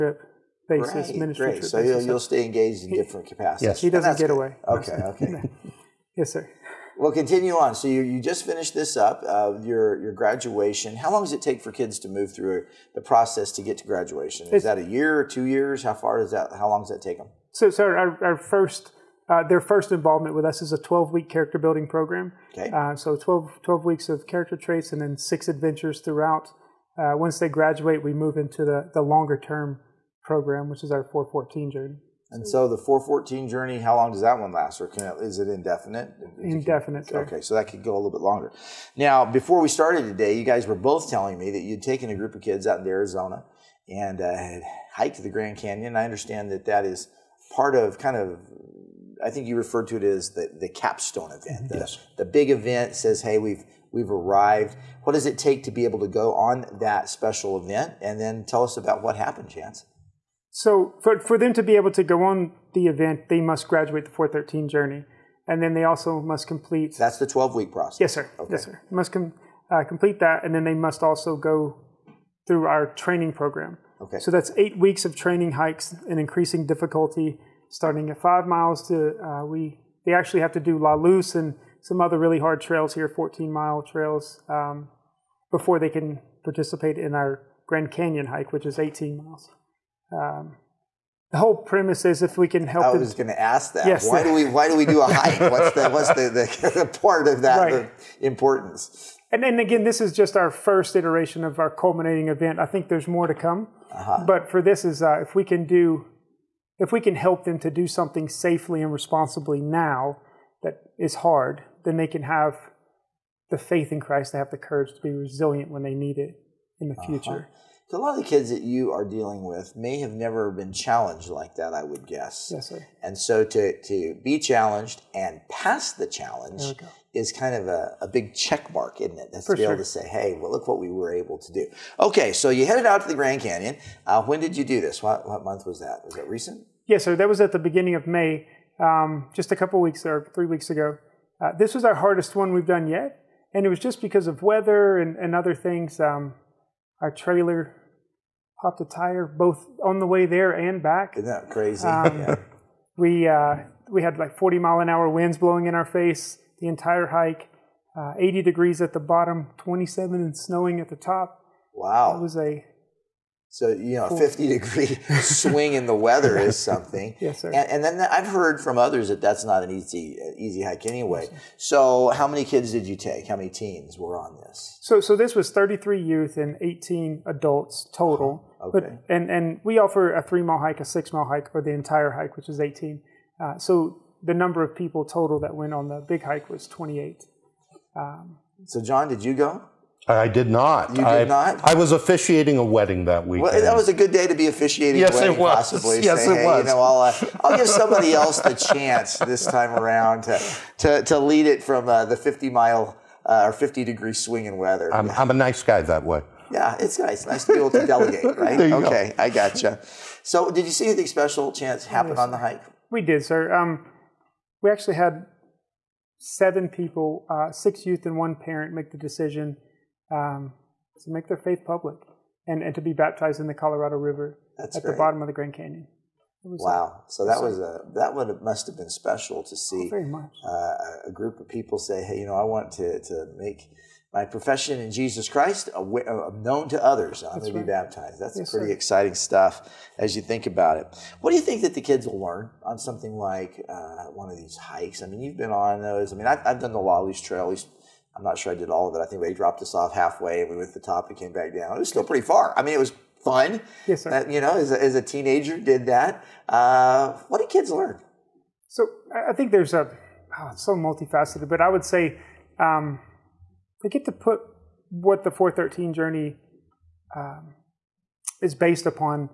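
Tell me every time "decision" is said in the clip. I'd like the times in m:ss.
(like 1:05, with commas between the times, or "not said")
3:38.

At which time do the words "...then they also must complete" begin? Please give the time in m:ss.
1:05.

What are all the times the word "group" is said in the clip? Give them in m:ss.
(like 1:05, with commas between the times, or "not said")
0:42, 3:51.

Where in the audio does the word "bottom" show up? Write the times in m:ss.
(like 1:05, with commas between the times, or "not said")
2:38, 3:44.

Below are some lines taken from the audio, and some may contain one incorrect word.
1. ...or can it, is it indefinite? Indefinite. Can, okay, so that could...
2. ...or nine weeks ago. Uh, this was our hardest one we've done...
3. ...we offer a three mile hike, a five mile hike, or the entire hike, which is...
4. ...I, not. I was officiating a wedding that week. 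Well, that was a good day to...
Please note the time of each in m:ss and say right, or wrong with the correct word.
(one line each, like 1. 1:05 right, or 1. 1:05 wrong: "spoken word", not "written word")
1. 0:34 right
2. 2:20 wrong: "three", not "nine"
3. 2:59 wrong: "six", not "five"
4. 3:11 right.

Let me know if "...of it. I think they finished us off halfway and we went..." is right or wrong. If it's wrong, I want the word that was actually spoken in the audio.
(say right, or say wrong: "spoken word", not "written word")
wrong: "dropped", not "finished".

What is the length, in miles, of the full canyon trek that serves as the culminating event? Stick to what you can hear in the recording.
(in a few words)
18.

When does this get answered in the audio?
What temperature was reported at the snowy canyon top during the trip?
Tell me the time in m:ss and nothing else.
2:39.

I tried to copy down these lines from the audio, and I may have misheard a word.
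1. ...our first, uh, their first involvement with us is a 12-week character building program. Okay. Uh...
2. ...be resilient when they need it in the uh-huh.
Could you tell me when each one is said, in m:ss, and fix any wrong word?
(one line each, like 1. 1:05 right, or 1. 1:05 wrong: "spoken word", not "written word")
1. 0:18 right
2. 1:55 right.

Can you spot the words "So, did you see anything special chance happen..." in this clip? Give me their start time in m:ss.
3:30.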